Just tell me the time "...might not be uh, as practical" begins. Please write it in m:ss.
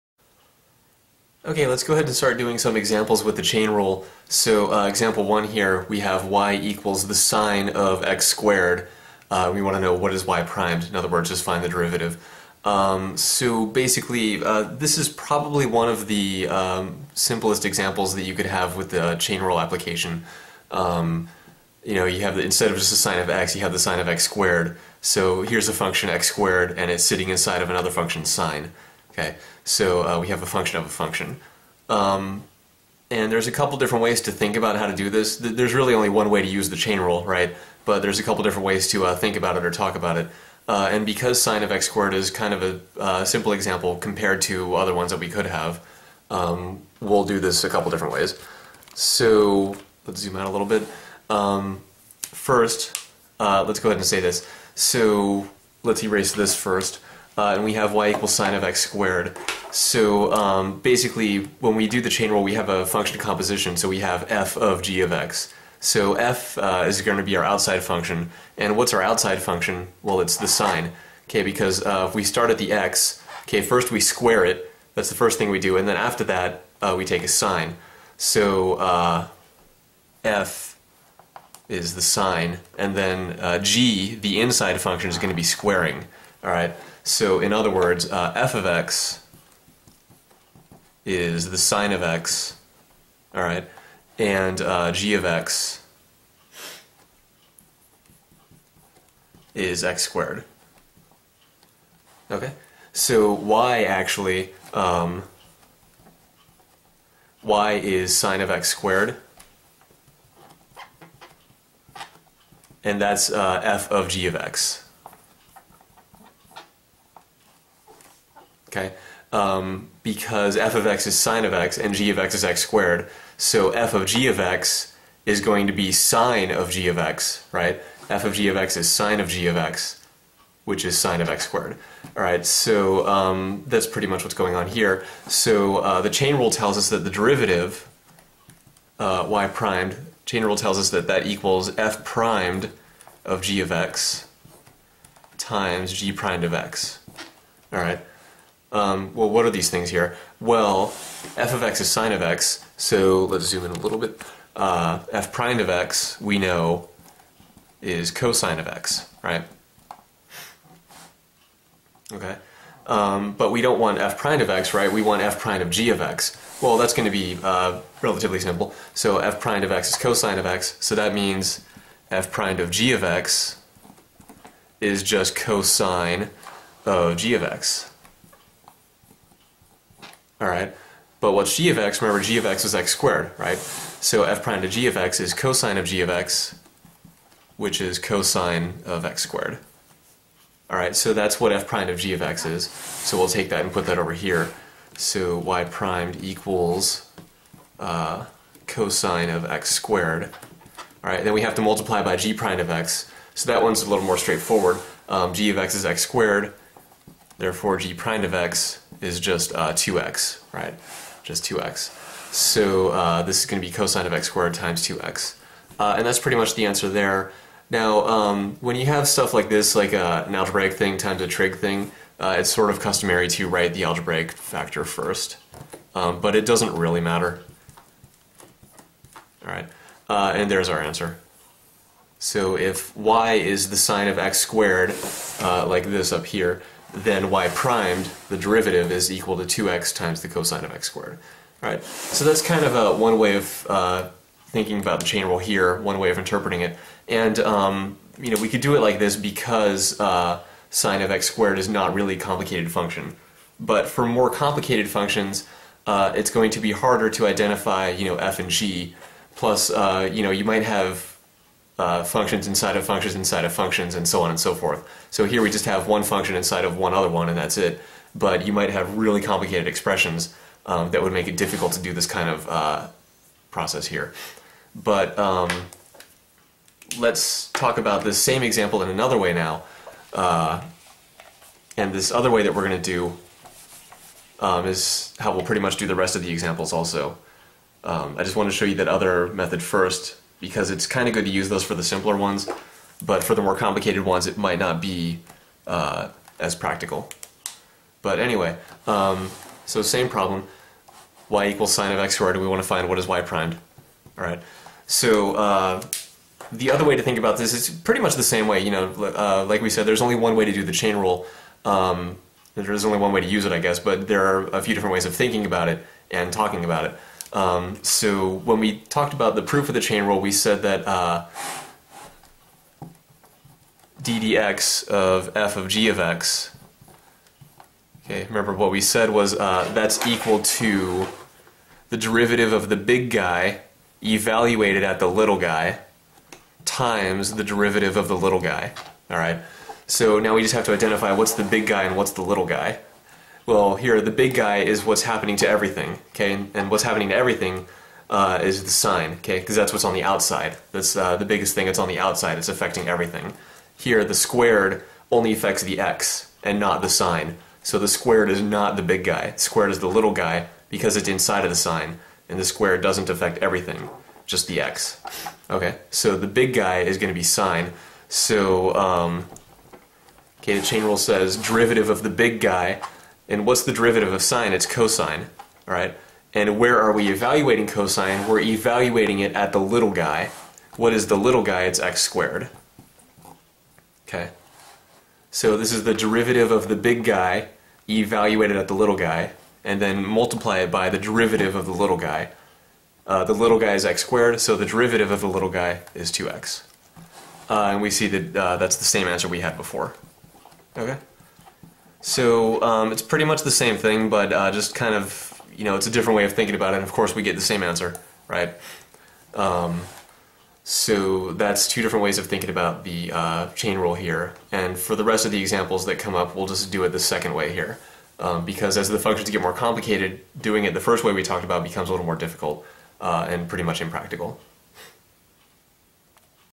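4:54.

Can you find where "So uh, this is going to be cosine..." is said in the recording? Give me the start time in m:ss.
3:32.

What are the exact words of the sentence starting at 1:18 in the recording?
So uh, f is the sine, and then uh, g, the inside function, is going to be squaring, all right?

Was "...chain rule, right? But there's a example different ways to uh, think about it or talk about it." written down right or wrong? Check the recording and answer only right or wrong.
wrong.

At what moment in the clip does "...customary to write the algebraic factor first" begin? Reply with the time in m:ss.
3:42.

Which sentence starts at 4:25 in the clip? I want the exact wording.
So here we just have one function inside of one other one and that's it.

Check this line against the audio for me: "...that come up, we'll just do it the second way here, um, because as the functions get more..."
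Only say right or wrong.
right.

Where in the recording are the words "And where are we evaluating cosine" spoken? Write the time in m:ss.
6:16.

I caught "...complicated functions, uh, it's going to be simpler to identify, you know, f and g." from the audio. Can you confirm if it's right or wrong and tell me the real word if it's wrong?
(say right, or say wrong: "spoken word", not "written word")
wrong: "harder", not "simpler".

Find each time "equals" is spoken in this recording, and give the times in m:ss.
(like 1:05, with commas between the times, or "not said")
0:06, 0:58, 2:21, 3:16, 3:59, 5:01, 5:30.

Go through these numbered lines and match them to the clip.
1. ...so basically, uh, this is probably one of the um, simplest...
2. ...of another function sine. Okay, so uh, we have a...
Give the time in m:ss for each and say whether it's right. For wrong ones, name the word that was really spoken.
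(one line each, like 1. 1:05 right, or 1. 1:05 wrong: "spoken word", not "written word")
1. 0:13 right
2. 0:27 right.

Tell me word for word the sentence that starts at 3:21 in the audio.
All right, then we have to multiply by g prime of x.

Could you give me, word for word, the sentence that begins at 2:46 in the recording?
Well, that's going to be uh, relatively simple.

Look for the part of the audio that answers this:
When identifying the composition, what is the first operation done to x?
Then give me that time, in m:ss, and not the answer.
1:14.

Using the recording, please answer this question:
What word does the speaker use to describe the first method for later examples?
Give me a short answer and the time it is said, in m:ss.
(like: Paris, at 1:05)
impractical, at 7:03.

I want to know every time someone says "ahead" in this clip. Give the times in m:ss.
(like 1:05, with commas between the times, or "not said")
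0:01, 0:53.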